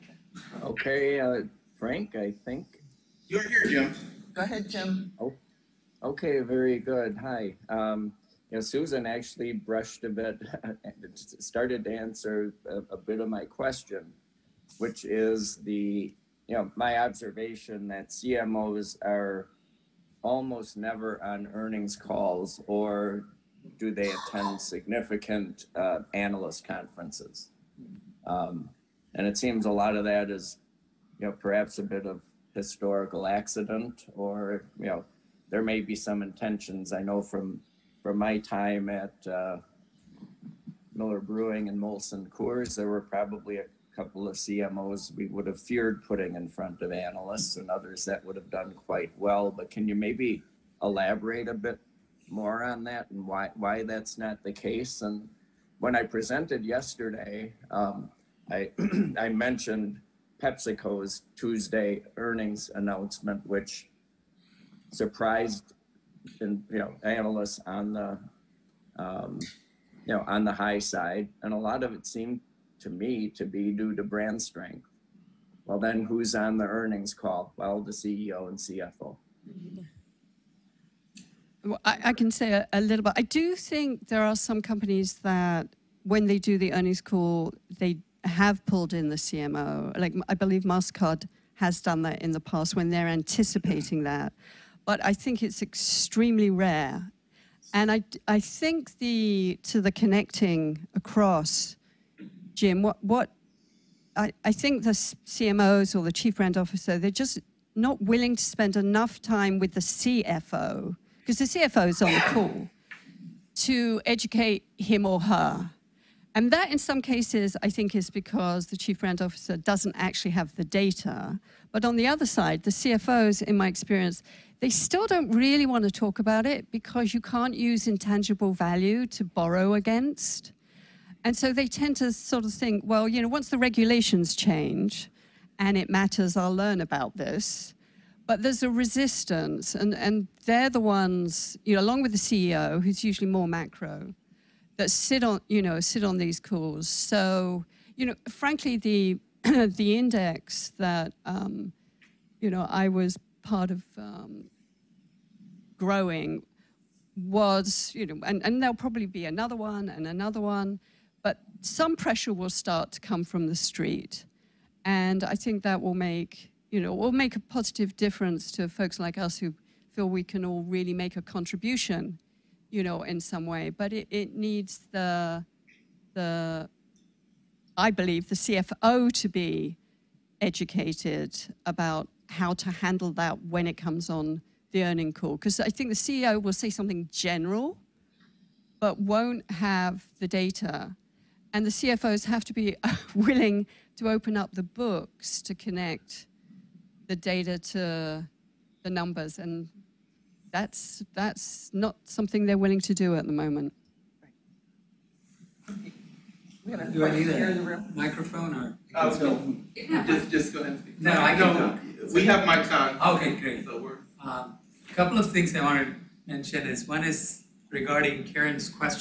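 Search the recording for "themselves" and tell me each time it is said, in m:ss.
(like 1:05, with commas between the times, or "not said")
not said.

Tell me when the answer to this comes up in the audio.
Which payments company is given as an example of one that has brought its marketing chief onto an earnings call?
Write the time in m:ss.
1:30.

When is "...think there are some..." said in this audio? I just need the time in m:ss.
1:23.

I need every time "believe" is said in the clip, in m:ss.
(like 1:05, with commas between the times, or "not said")
1:30, 2:57.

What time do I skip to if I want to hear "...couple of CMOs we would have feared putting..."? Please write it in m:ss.
0:43.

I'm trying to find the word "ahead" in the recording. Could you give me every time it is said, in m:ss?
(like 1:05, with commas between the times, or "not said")
0:04, 3:30.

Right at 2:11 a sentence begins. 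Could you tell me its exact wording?
And so they tend to sort of think, well, you know, once the regulations change and it matters, I'll learn about this.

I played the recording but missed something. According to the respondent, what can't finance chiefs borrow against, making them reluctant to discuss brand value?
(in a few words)
Intangible value.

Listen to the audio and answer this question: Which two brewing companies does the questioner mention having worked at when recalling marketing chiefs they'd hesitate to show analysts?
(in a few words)
Miller Brewing and Molson Coors.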